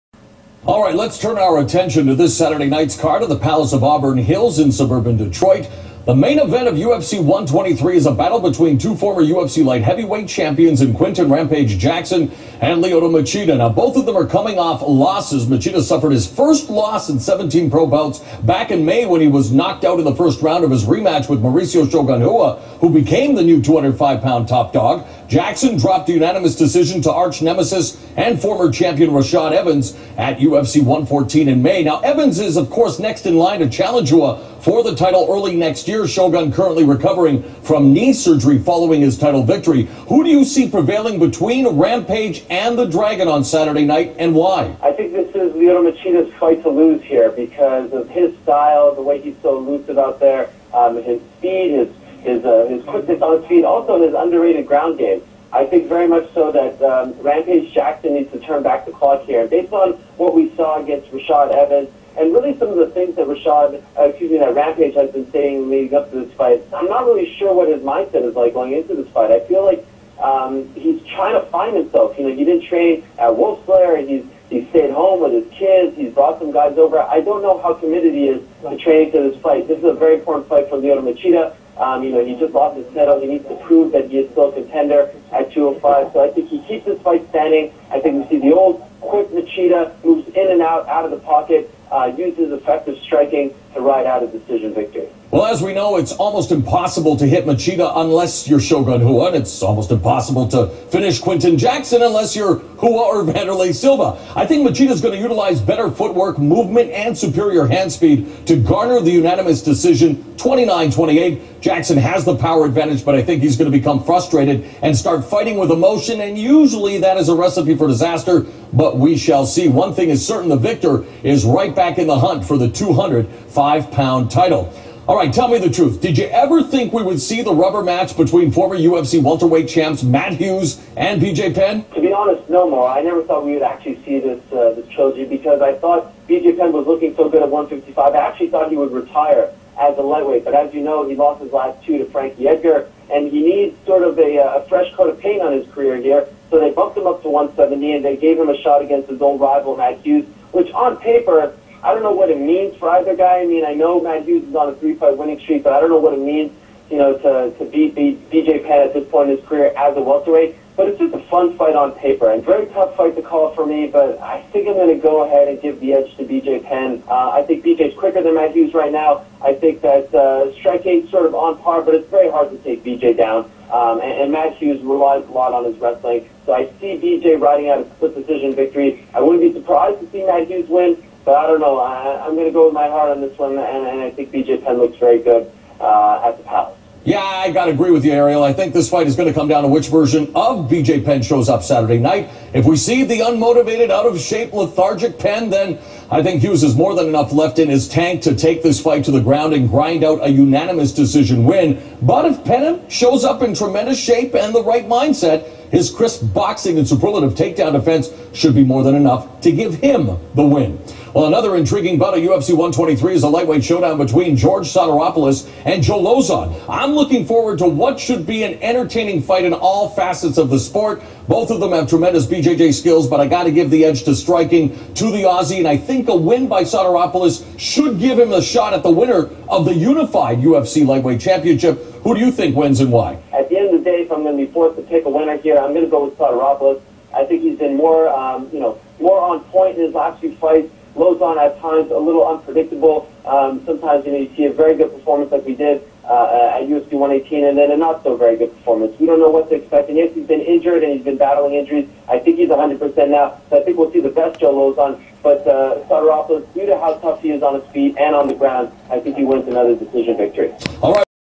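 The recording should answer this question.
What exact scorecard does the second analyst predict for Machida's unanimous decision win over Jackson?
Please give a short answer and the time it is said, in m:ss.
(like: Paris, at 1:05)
29-28, at 1:50.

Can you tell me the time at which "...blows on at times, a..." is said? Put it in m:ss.
4:01.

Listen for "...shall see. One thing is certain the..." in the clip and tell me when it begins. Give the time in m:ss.
1:59.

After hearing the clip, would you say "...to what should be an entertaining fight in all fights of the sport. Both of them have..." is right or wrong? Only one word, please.
wrong.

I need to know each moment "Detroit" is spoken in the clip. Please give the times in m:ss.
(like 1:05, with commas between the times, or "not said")
0:05.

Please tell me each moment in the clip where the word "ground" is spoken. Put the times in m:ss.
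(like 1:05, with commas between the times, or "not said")
0:54, 3:19, 4:18.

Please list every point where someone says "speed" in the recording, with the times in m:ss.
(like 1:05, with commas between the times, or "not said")
0:51, 1:47.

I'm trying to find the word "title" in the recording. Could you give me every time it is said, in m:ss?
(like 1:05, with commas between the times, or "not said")
0:34, 0:39, 1:22, 2:04.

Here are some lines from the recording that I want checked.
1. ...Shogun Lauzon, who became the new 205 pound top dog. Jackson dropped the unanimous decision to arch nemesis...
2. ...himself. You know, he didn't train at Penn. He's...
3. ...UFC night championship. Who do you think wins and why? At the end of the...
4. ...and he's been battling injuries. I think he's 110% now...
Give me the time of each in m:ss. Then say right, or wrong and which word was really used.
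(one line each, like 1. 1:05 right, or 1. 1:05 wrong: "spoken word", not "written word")
1. 0:21 wrong: "Rua", not "Lauzon"
2. 1:11 wrong: "Wolfslair", not "Penn"
3. 3:50 wrong: "lightweight", not "night"
4. 4:10 wrong: "100", not "110".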